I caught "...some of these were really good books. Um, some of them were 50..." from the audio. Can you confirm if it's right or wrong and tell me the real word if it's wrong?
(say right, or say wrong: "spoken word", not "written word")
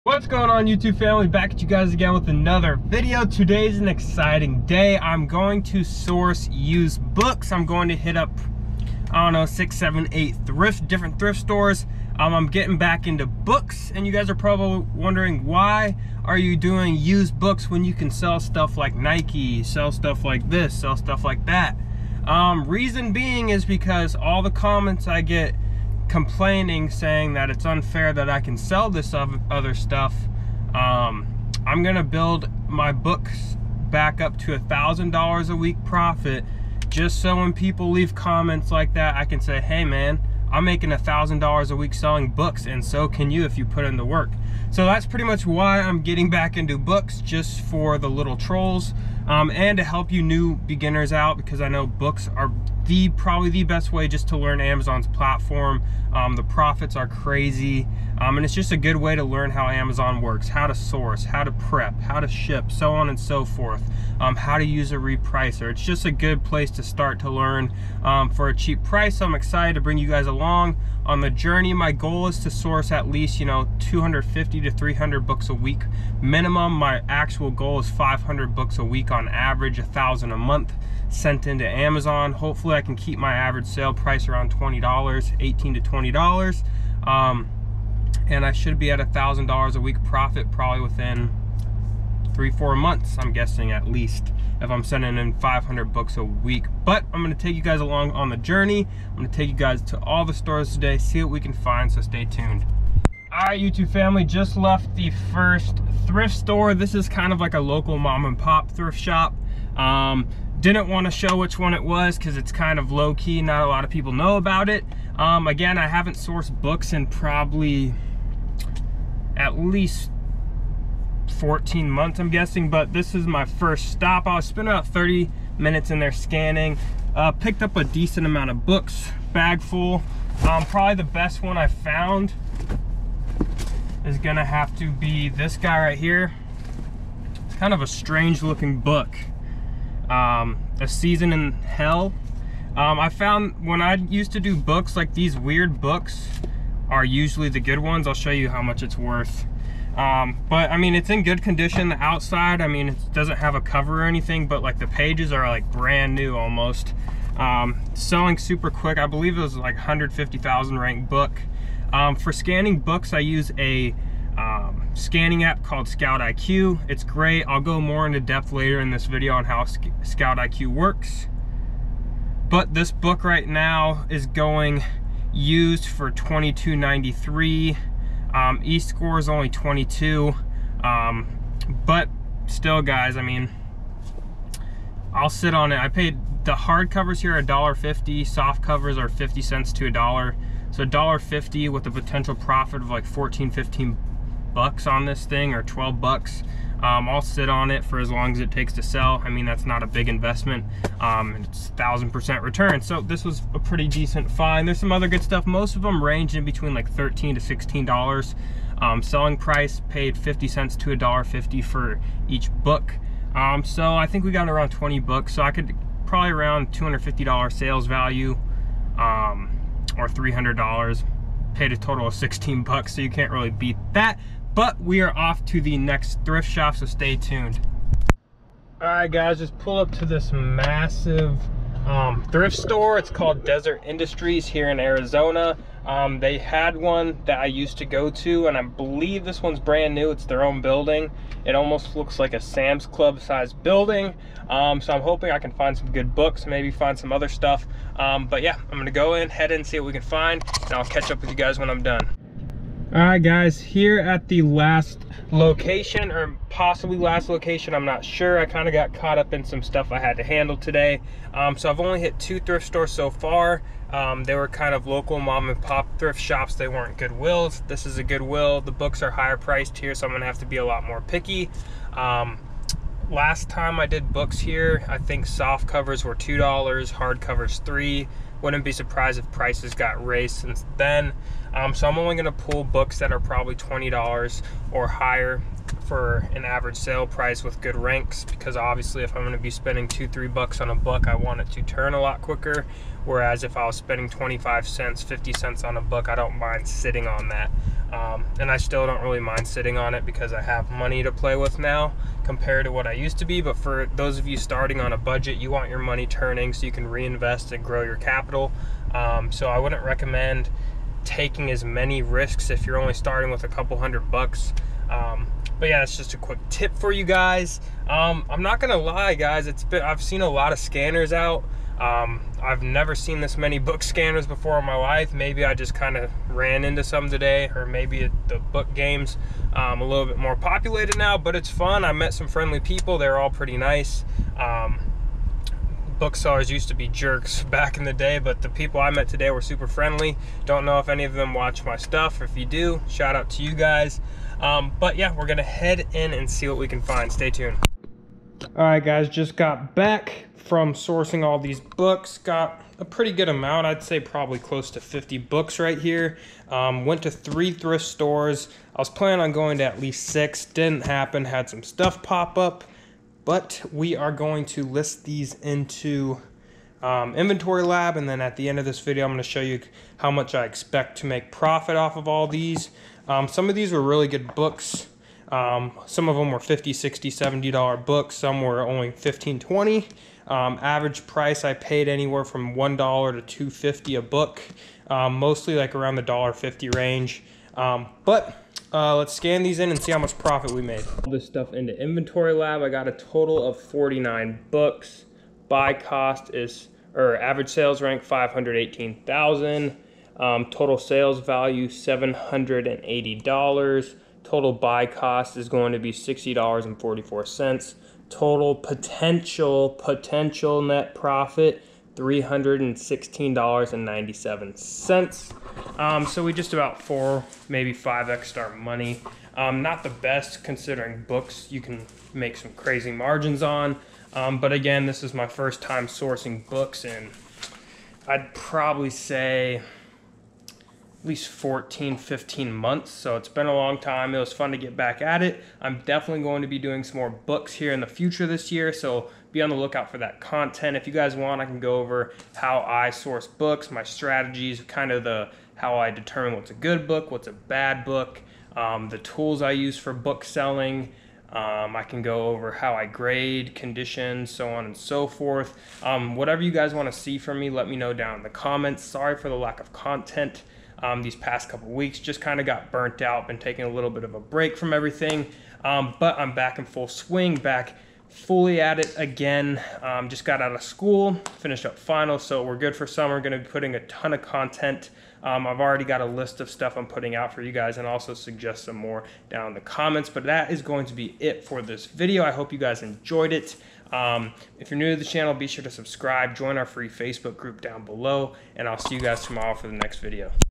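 right.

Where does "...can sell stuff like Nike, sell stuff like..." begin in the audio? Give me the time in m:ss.
0:17.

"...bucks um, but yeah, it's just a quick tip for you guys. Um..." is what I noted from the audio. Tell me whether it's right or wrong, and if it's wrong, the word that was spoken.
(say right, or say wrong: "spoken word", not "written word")
right.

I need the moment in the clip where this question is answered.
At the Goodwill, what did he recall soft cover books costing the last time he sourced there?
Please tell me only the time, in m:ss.
4:36.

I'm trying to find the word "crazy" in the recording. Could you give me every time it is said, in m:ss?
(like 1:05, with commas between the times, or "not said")
0:57, 7:02.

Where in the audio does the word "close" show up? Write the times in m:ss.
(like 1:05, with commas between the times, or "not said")
5:54.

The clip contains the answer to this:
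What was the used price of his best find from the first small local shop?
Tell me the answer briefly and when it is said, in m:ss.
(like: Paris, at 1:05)
$22.93, at 2:56.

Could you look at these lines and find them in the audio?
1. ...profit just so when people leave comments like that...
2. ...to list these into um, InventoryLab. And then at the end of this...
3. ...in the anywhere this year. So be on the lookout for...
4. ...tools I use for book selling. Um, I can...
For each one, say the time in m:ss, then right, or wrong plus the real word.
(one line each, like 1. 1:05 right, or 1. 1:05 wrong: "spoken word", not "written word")
1. 0:35 right
2. 6:04 right
3. 7:17 wrong: "future", not "anywhere"
4. 7:28 right.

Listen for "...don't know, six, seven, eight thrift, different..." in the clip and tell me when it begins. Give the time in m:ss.
0:09.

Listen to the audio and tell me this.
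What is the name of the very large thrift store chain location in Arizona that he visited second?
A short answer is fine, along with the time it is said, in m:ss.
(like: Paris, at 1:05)
Deseret Industries, at 3:53.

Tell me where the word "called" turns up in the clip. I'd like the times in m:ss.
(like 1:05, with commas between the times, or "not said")
2:45, 3:53.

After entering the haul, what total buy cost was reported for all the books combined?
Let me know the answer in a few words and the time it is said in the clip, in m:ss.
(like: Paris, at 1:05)
$60.44, at 6:45.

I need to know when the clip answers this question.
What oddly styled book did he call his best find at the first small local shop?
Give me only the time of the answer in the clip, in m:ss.
2:20.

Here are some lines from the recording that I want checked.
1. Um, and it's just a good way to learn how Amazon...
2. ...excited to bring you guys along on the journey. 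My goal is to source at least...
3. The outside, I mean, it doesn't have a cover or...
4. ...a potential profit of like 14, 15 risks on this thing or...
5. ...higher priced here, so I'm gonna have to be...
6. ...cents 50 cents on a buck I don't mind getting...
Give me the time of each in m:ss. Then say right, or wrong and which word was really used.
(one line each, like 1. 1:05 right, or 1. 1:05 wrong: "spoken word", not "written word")
1. 0:58 right
2. 1:09 right
3. 2:31 right
4. 3:11 wrong: "bucks", not "risks"
5. 4:29 right
6. 4:54 wrong: "sitting", not "getting".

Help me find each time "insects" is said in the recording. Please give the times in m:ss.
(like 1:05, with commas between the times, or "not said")
not said.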